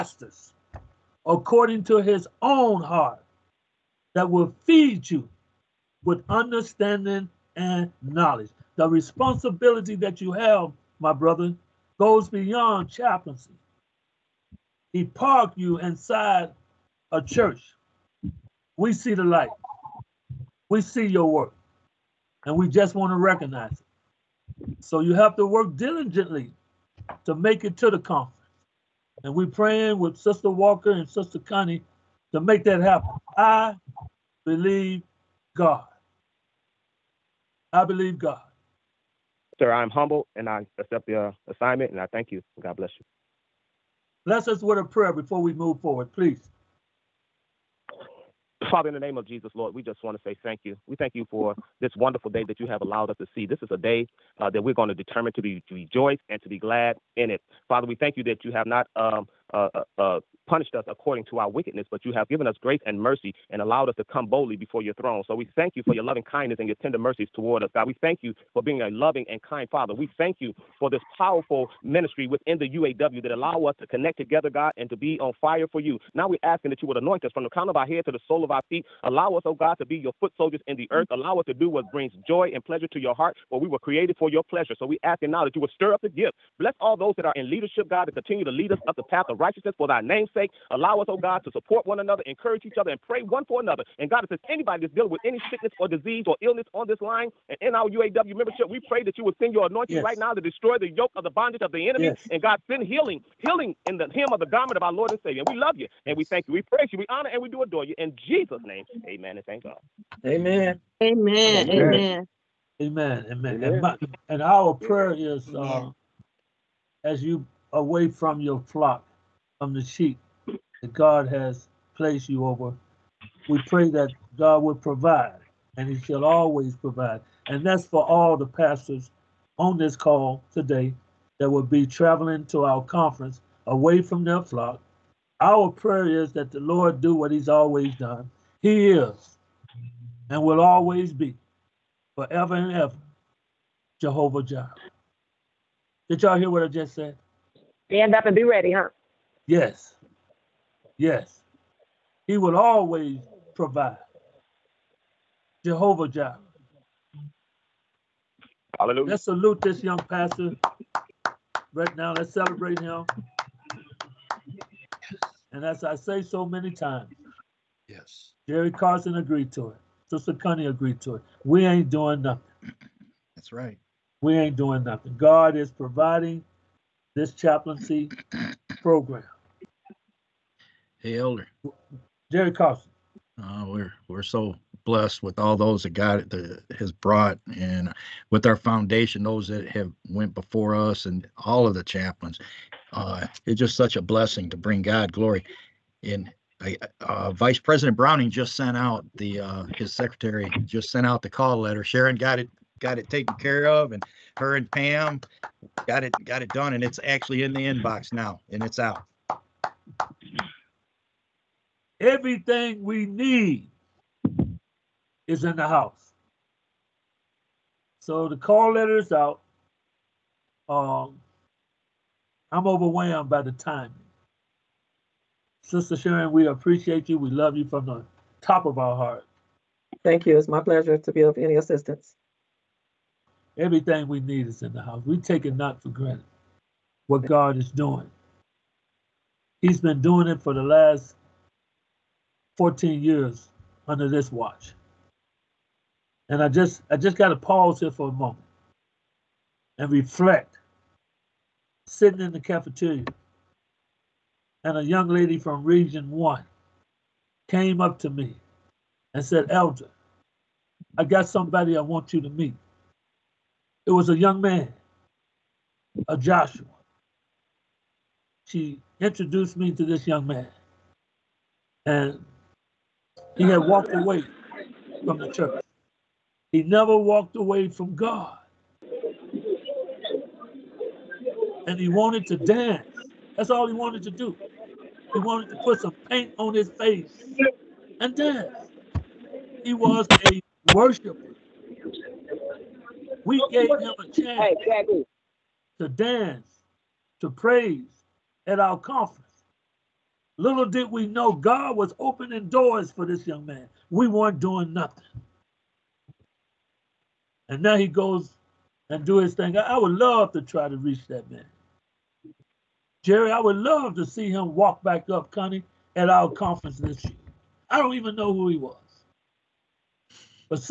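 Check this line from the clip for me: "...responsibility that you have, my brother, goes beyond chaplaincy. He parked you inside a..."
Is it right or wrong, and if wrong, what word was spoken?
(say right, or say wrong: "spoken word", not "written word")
right.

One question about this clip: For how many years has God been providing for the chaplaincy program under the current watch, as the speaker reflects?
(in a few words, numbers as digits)
14.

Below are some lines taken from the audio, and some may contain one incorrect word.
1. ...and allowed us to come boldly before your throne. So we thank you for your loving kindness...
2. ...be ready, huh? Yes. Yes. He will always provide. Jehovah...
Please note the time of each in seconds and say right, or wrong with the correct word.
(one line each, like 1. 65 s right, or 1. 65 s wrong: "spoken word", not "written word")
1. 63 s right
2. 148 s right.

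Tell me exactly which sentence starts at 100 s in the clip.
right now to destroy the yoke of the bondage of the enemy.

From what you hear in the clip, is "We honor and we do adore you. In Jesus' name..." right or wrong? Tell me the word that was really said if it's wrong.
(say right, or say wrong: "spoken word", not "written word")
right.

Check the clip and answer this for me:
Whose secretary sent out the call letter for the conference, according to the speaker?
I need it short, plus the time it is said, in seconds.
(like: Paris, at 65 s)
Vice President Browning, at 197 s.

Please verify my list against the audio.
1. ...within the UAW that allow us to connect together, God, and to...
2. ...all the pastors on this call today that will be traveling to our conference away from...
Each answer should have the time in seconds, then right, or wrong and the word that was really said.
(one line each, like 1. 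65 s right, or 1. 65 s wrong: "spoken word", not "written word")
1. 72 s right
2. 128 s right.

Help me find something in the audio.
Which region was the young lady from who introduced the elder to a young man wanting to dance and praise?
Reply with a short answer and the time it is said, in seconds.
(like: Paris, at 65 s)
Region one, at 255 s.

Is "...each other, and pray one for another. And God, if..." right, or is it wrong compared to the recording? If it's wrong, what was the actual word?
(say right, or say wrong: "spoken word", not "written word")
right.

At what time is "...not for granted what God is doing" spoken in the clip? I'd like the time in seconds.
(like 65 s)
235 s.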